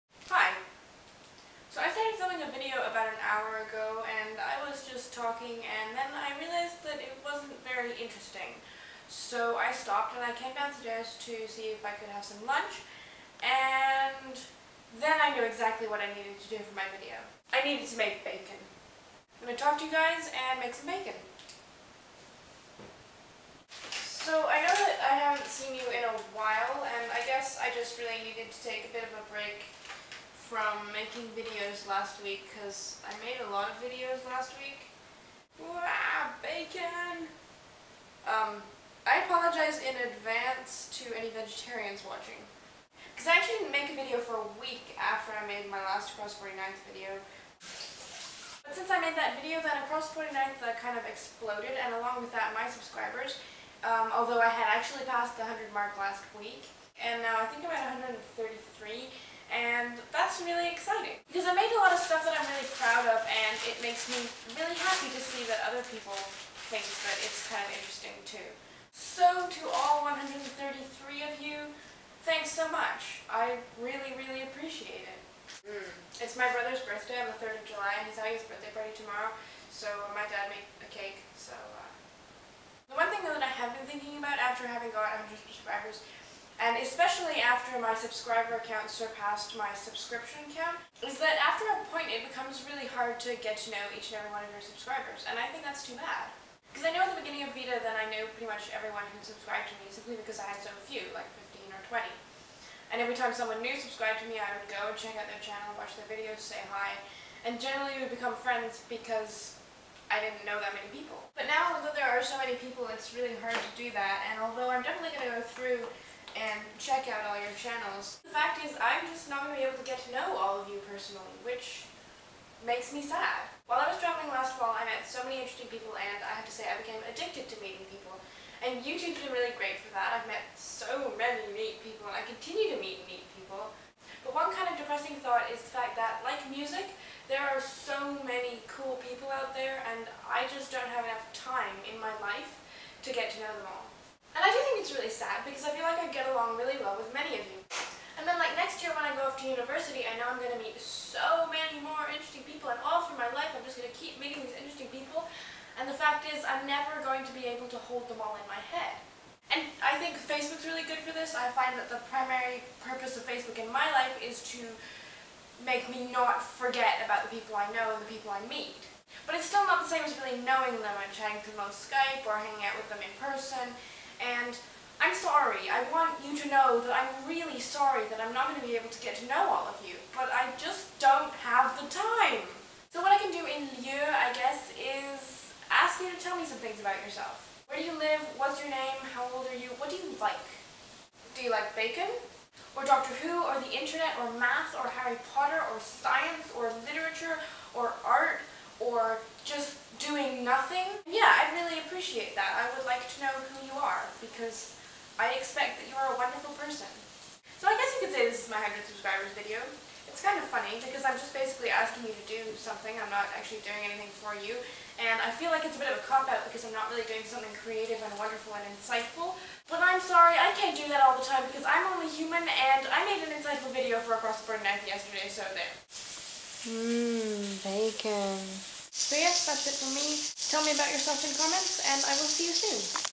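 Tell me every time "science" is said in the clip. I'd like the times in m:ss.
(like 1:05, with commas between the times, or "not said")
3:15.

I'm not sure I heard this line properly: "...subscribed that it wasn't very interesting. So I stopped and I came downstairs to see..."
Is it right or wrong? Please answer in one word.
wrong.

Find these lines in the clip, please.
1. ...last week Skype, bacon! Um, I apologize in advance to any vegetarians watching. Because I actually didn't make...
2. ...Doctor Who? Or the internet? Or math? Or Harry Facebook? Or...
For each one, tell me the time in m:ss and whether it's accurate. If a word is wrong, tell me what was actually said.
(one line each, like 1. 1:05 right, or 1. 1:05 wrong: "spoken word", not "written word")
1. 0:34 wrong: "Wow", not "Skype"
2. 3:12 wrong: "Potter", not "Facebook".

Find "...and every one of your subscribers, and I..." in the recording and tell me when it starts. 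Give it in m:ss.
1:34.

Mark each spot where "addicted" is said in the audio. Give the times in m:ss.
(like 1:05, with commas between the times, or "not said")
2:07.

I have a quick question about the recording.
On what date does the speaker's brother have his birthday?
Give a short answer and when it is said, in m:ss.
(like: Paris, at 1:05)
3rd of July, at 1:17.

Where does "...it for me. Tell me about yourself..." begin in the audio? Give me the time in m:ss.
3:49.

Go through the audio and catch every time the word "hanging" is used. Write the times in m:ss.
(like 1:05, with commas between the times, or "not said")
2:52.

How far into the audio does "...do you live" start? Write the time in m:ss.
3:07.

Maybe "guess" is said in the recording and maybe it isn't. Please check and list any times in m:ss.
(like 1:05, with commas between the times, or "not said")
0:27, 3:04, 3:27.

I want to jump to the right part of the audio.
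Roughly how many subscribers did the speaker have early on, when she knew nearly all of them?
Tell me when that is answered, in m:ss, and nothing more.
1:41.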